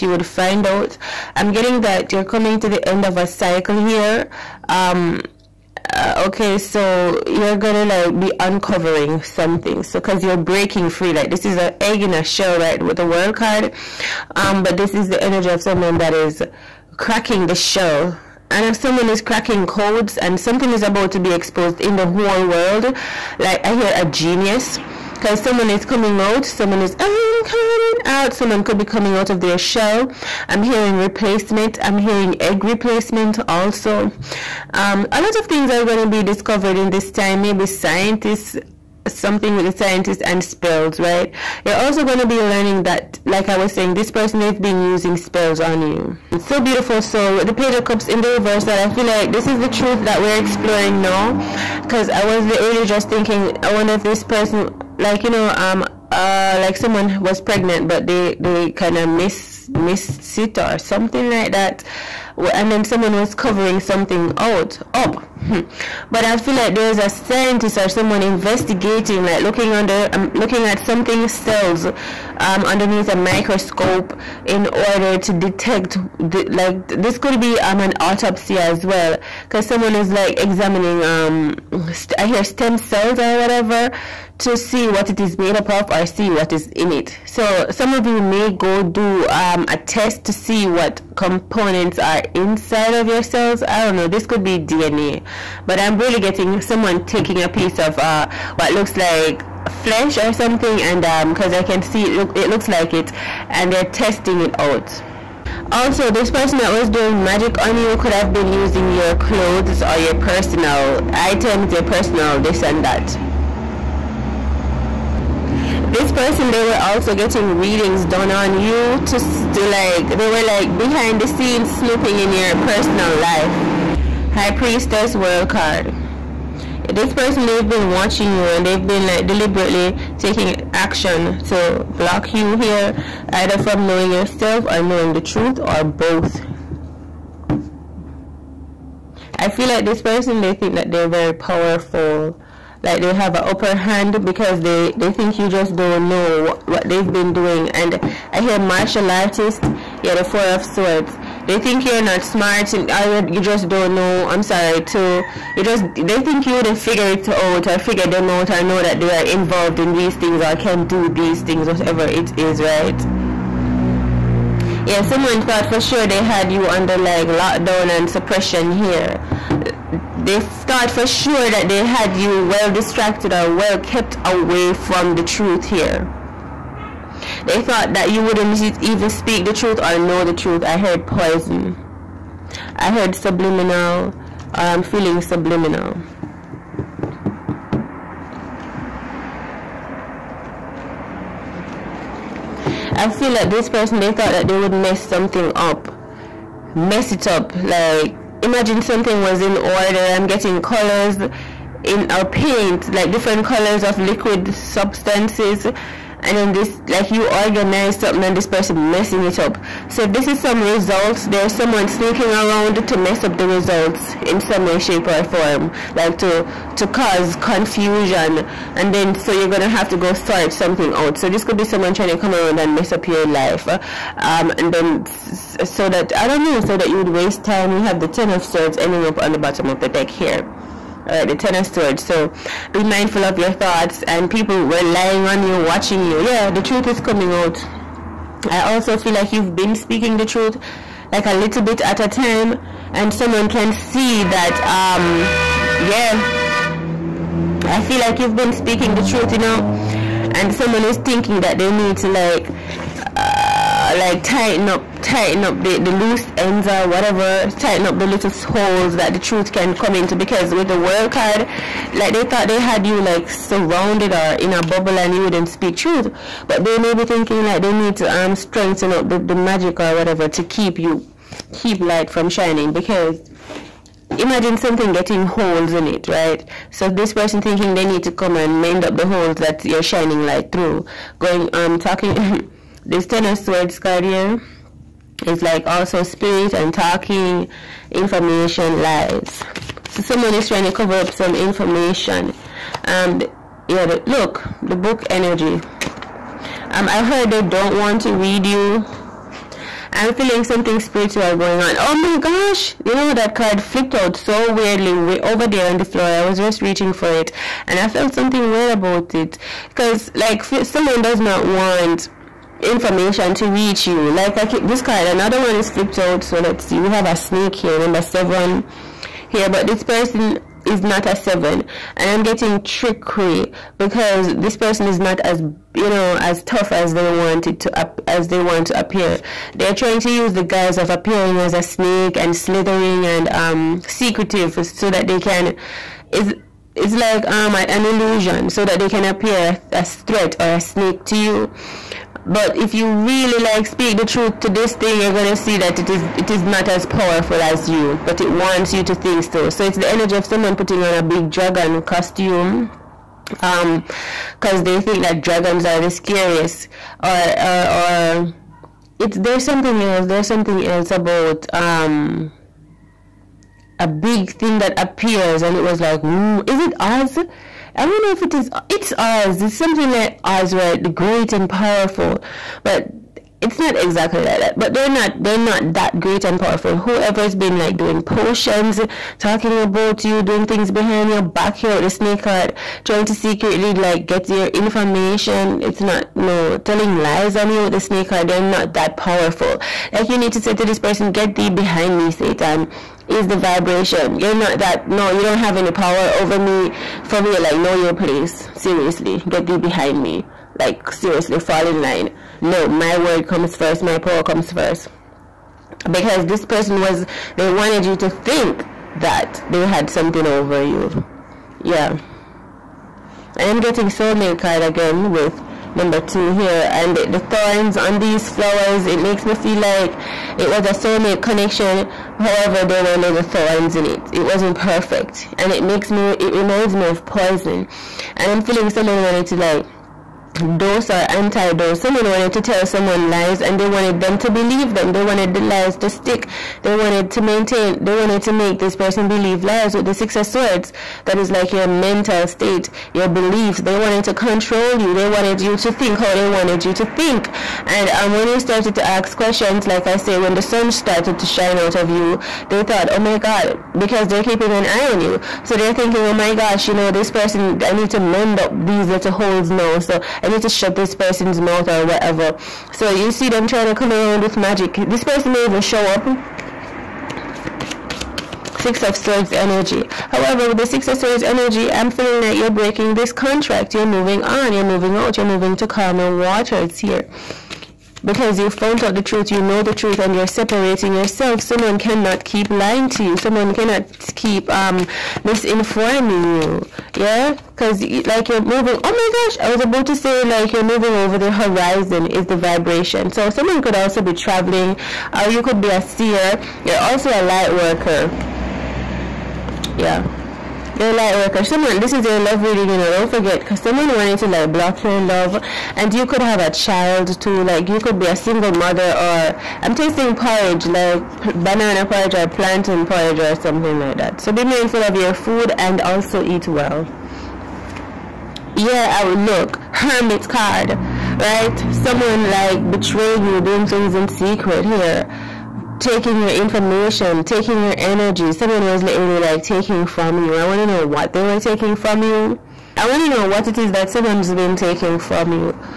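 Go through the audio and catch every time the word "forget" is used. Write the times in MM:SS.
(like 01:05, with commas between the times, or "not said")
08:23.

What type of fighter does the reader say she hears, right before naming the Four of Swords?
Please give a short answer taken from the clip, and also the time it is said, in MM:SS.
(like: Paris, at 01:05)
Martial artists, at 02:28.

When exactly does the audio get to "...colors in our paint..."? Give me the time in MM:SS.
03:20.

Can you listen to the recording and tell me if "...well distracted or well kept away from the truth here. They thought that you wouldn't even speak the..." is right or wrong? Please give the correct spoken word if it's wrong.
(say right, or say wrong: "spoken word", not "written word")
right.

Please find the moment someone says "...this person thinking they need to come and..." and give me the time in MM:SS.
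04:36.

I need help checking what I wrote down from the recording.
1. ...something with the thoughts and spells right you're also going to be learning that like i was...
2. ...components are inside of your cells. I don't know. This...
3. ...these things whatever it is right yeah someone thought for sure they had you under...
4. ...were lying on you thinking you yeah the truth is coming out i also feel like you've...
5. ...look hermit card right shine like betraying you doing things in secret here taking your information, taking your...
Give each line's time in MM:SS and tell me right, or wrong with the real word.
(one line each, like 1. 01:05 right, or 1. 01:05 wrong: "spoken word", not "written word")
1. 00:39 wrong: "scientists", not "thoughts"
2. 01:31 right
3. 02:41 right
4. 03:54 wrong: "watching", not "thinking"
5. 08:39 wrong: "someone", not "shine".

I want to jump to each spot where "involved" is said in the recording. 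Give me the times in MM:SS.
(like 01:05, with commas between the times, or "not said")
02:39.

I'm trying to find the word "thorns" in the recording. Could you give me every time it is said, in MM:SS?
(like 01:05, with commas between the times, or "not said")
06:57, 07:03.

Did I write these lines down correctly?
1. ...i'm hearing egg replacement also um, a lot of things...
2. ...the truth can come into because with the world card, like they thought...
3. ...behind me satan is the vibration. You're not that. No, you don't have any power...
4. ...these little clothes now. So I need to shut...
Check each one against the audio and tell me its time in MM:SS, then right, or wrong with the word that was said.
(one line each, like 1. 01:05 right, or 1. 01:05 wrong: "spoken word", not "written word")
1. 00:31 right
2. 04:19 right
3. 06:31 right
4. 07:38 wrong: "holes", not "clothes".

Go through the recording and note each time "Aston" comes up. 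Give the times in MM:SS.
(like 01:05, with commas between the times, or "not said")
not said.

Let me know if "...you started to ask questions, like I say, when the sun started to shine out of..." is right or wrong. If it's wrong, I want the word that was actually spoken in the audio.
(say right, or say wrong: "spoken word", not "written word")
right.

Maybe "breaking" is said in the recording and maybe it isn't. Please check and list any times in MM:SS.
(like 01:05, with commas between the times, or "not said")
00:10, 07:52.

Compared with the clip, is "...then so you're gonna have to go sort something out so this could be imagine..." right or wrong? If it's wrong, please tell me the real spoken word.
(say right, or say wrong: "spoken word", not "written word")
wrong: "someone", not "imagine".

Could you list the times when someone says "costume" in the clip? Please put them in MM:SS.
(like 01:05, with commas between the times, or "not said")
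05:51.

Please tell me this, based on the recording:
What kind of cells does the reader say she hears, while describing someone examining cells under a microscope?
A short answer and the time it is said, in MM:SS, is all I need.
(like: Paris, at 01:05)
Stem cells, at 01:22.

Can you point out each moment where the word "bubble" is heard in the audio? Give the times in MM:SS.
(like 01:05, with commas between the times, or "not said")
04:24.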